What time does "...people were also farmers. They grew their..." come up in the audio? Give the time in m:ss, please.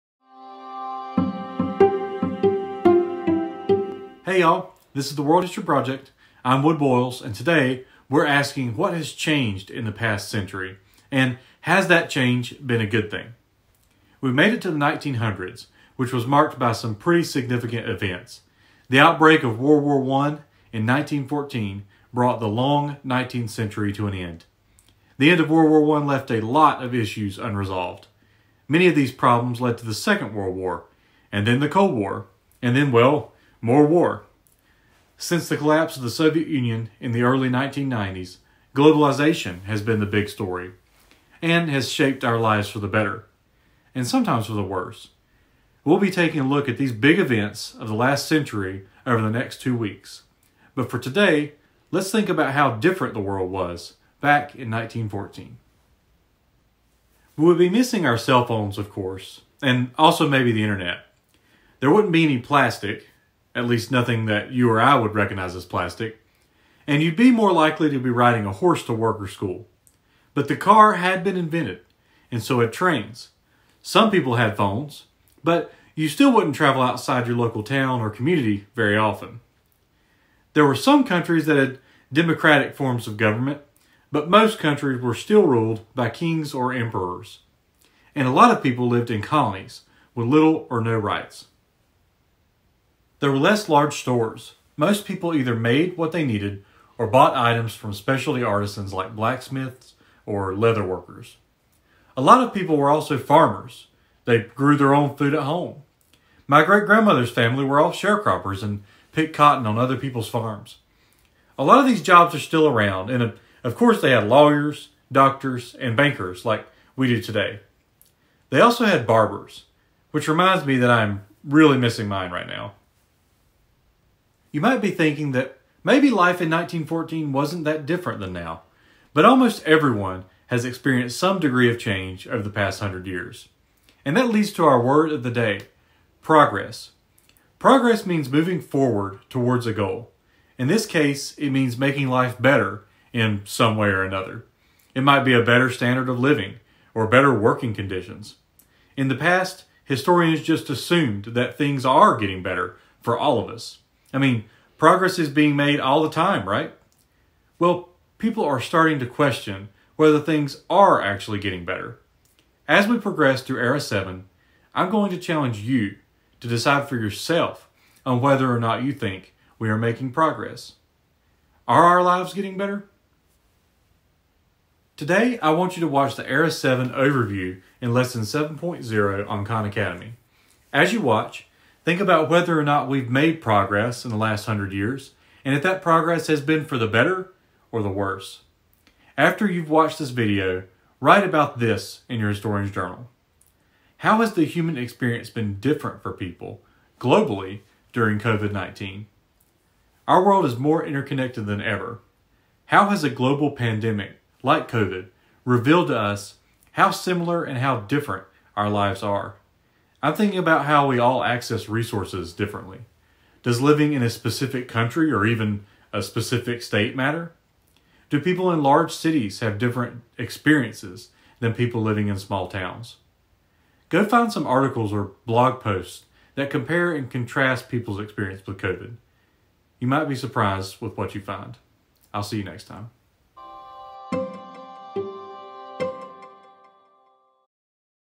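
1:42.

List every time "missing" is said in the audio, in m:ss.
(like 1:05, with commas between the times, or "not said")
0:57, 2:01.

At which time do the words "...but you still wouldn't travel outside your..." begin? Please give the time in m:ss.
1:15.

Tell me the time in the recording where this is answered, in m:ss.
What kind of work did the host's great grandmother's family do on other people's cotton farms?
1:47.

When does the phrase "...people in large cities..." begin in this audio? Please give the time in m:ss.
3:38.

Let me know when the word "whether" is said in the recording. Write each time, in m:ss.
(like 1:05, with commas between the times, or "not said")
2:39, 2:48, 3:02.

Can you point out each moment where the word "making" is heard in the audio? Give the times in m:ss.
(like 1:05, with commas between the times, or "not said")
2:21, 2:49.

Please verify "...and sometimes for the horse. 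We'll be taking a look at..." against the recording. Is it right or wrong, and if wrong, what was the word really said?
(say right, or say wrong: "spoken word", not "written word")
wrong: "worse", not "horse".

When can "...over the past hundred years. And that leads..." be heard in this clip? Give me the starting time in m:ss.
2:12.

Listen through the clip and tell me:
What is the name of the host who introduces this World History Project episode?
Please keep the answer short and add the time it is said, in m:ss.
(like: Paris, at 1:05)
Wood Boyles, at 0:06.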